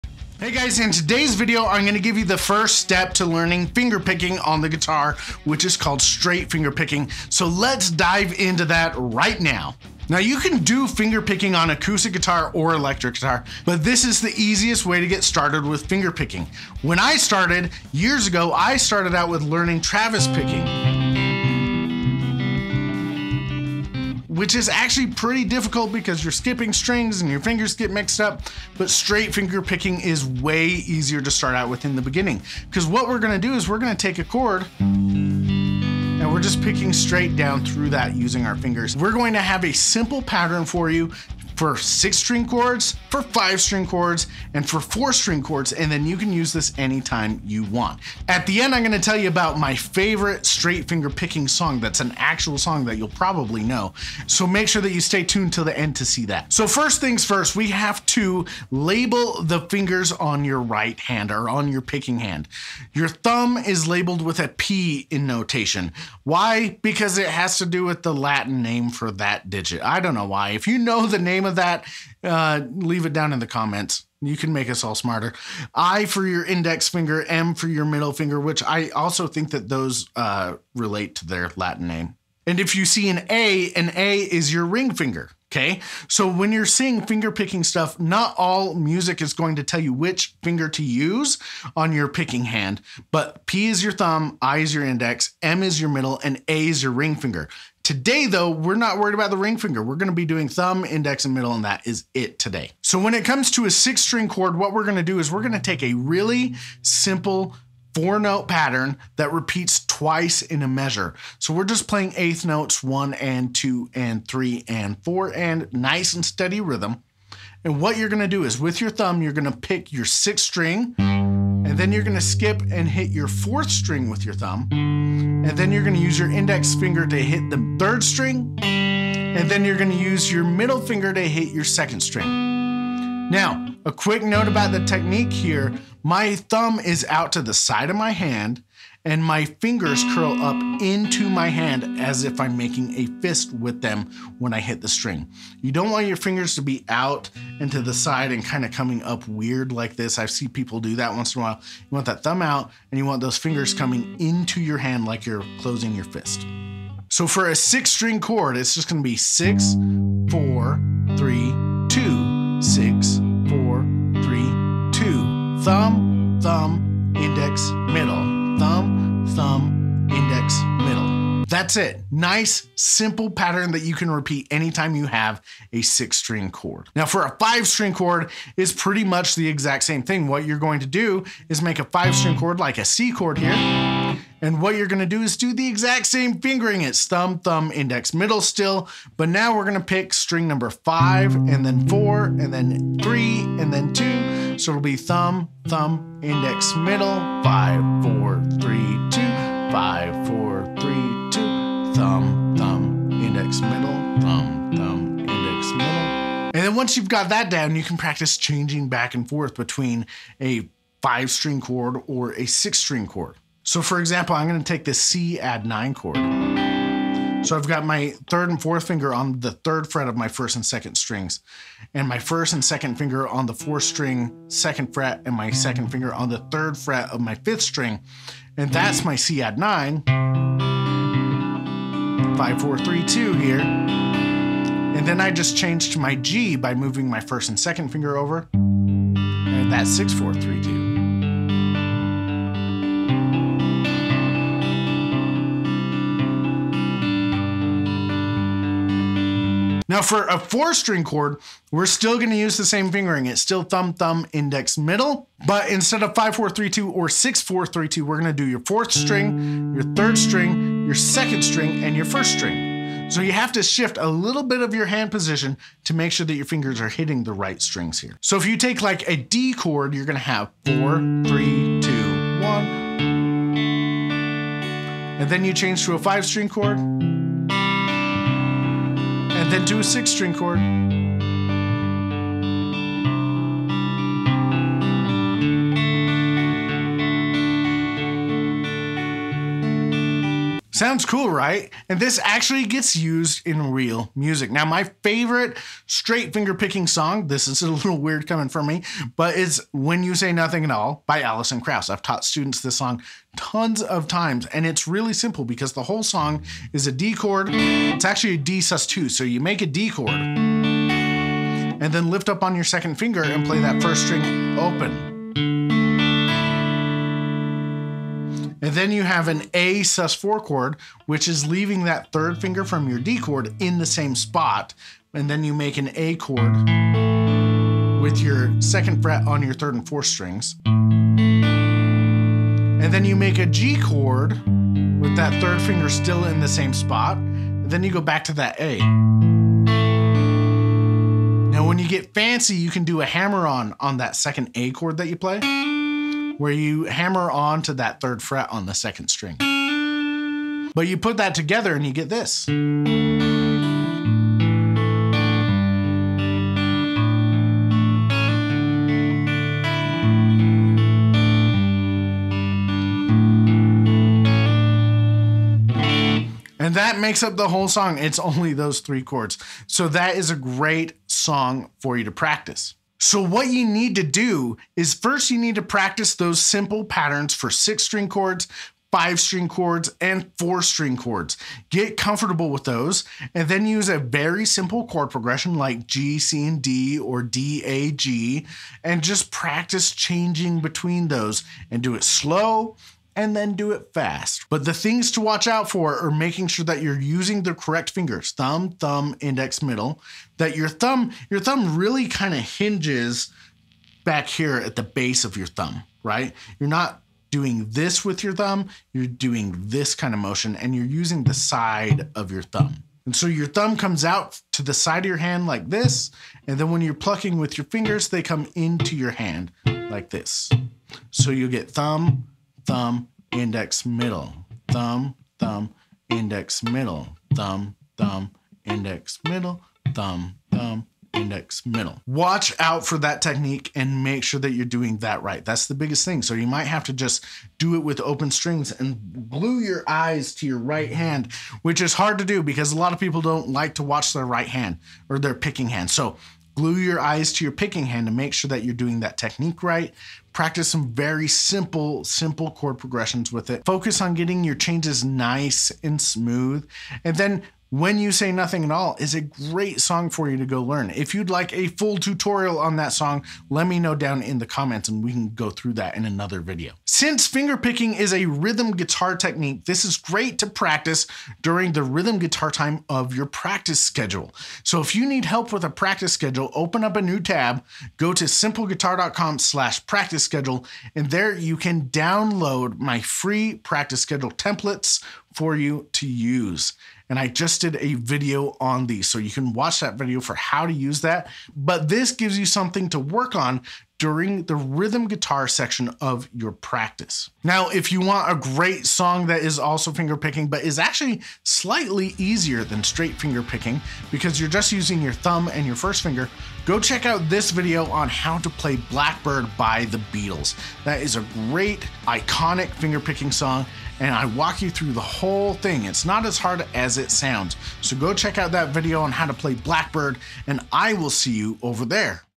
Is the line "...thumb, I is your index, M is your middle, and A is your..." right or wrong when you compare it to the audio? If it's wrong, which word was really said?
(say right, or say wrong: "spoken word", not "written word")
right.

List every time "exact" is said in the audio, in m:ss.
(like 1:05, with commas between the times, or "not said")
2:59, 3:05.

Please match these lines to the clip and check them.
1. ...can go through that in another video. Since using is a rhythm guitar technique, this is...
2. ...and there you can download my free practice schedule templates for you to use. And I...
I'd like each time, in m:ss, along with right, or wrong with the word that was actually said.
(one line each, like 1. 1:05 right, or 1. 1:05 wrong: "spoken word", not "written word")
1. 7:45 wrong: "fingerpicking", not "using"
2. 8:00 right.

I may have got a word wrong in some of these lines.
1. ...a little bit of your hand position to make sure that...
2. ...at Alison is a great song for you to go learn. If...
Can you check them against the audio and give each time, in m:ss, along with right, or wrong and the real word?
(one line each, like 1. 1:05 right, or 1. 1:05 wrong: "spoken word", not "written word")
1. 4:23 right
2. 7:38 wrong: "All", not "Alison".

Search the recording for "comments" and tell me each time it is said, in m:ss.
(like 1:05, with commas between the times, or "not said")
1:13, 7:44.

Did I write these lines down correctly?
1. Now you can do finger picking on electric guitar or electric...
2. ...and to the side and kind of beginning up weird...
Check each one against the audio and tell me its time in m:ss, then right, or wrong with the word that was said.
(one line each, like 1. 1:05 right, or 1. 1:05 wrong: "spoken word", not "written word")
1. 0:10 wrong: "acoustic", not "electric"
2. 2:27 wrong: "coming", not "beginning".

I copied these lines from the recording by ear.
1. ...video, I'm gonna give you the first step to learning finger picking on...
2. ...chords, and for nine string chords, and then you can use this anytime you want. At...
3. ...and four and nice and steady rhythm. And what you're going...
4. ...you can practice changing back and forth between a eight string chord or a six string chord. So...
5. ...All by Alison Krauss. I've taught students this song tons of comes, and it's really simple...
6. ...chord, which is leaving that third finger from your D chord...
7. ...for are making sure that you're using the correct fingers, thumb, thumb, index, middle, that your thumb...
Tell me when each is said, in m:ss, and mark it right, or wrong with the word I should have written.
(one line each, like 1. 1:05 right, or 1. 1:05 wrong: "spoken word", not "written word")
1. 0:01 right
2. 0:43 wrong: "four", not "nine"
3. 1:54 right
4. 3:27 wrong: "five", not "eight"
5. 5:00 wrong: "times", not "comes"
6. 5:20 right
7. 6:35 right.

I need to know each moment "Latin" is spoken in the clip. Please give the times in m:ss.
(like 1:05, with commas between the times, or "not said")
1:08, 1:21.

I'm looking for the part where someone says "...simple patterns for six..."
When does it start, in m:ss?
6:16.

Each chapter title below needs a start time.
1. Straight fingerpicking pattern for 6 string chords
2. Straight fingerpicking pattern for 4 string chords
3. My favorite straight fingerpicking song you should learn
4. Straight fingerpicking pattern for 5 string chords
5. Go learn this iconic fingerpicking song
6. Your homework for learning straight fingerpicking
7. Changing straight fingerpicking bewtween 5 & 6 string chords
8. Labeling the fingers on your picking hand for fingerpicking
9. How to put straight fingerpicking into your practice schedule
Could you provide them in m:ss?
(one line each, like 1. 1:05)
1. 1:42
2. 4:09
3. 4:54
4. 2:56
5. 8:17
6. 6:12
7. 3:26
8. 0:56
9. 7:46.